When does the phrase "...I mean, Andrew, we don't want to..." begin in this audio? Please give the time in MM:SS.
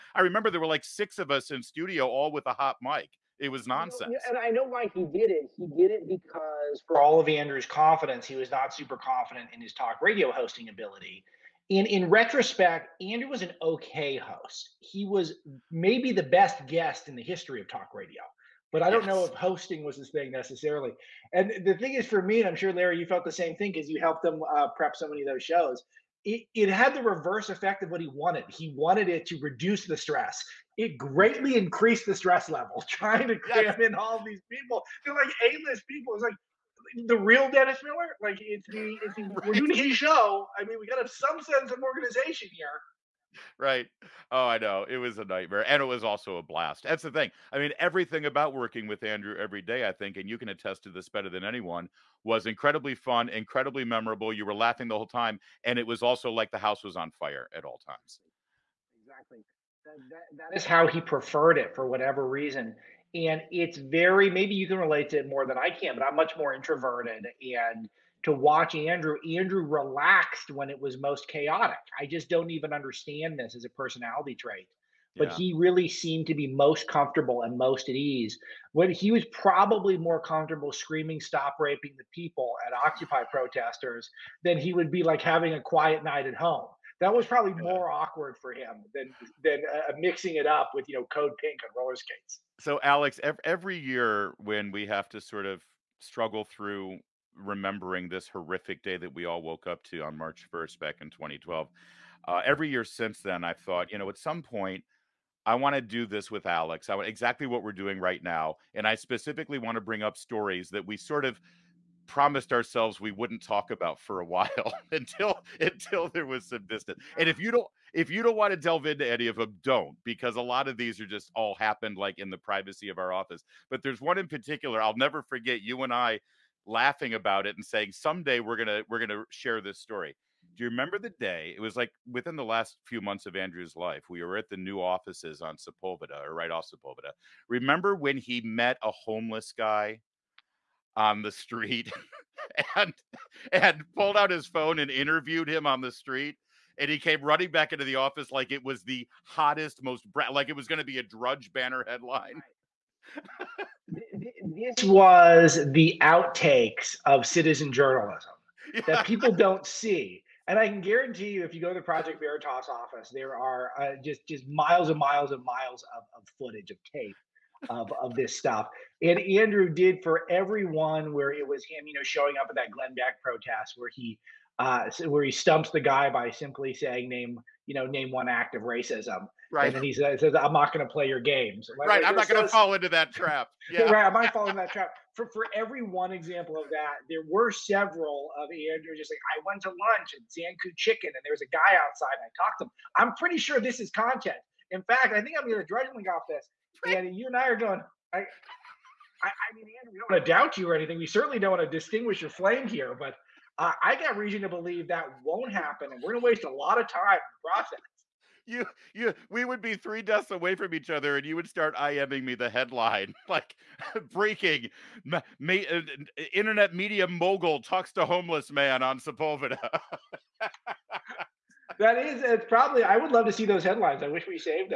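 03:18.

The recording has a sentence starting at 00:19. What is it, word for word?
know if hosting was his thing necessarily.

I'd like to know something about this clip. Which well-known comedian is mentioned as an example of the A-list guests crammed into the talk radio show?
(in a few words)
Dennis Miller.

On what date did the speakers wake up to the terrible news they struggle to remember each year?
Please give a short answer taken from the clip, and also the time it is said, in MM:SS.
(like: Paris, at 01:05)
March 1st, at 01:40.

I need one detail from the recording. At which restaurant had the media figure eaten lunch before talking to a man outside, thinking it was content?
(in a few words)
Zankou Chicken.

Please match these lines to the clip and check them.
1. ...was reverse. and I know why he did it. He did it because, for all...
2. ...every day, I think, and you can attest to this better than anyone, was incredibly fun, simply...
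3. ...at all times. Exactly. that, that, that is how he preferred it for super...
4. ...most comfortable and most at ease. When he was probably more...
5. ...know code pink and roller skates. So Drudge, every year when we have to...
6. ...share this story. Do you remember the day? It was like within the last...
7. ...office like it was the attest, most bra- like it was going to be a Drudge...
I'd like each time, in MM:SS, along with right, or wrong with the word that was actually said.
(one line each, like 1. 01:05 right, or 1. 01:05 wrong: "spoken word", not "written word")
1. 00:03 wrong: "nonsense", not "reverse"
2. 00:49 wrong: "incredibly", not "simply"
3. 00:57 wrong: "whatever", not "super"
4. 01:16 right
5. 01:30 wrong: "Alex", not "Drudge"
6. 02:09 right
7. 02:27 wrong: "hottest", not "attest".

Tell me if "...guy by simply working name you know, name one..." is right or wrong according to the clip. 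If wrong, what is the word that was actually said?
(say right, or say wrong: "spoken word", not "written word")
wrong: "saying", not "working".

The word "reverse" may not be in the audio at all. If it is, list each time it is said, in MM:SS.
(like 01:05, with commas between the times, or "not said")
00:27.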